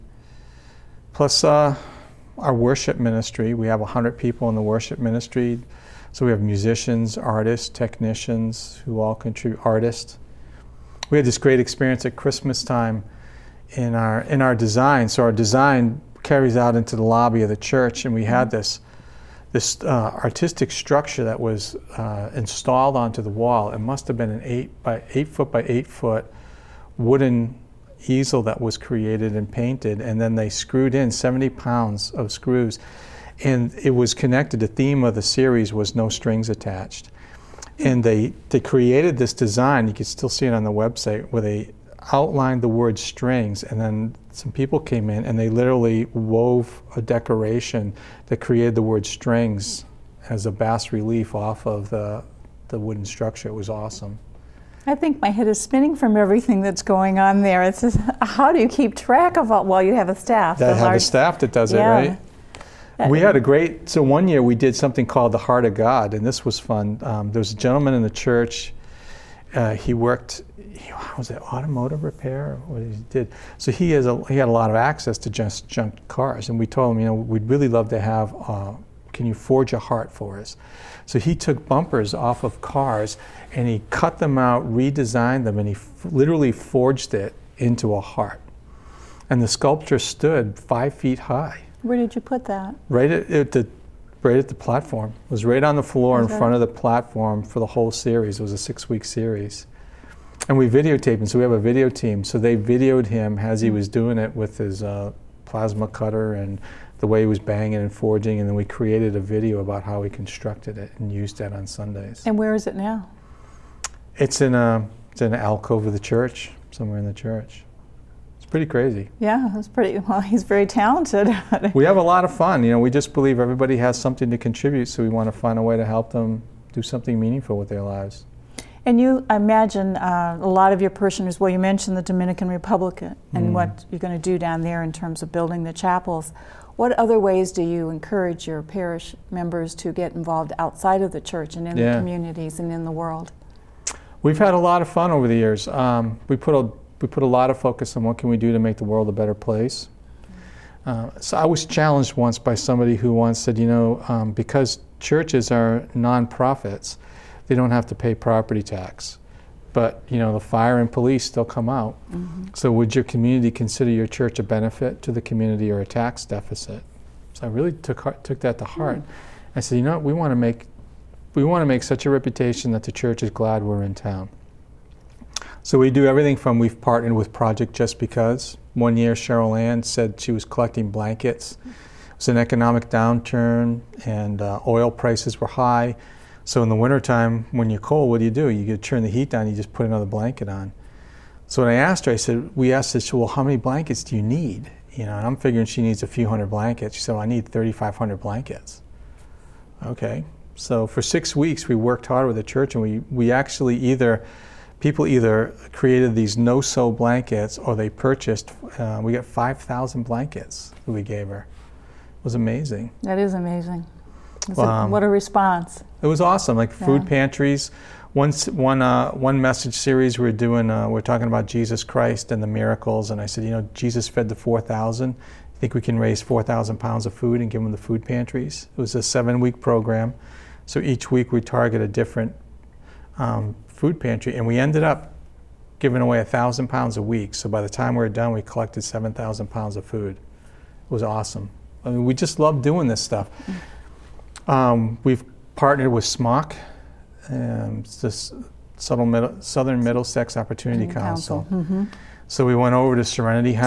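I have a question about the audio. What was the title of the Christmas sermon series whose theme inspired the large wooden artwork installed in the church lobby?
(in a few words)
No Strings Attached.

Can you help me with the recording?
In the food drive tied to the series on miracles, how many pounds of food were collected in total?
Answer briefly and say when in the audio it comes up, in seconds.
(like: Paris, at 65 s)
7,000 pounds, at 238 s.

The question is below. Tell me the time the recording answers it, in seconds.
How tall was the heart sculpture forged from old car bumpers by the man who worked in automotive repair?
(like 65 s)
90 s.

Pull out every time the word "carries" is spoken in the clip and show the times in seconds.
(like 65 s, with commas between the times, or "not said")
16 s.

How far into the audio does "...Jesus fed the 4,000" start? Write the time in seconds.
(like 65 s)
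223 s.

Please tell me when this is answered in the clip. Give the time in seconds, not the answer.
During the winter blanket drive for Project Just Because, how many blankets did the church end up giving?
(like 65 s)
209 s.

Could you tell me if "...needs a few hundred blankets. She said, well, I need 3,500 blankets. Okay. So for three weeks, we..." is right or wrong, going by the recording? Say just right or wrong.
wrong.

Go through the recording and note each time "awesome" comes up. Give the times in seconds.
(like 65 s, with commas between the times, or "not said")
53 s, 216 s, 241 s.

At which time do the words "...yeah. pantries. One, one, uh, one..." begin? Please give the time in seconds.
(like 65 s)
217 s.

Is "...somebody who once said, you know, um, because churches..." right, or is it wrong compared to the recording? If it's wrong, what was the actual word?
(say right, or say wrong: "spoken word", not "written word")
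right.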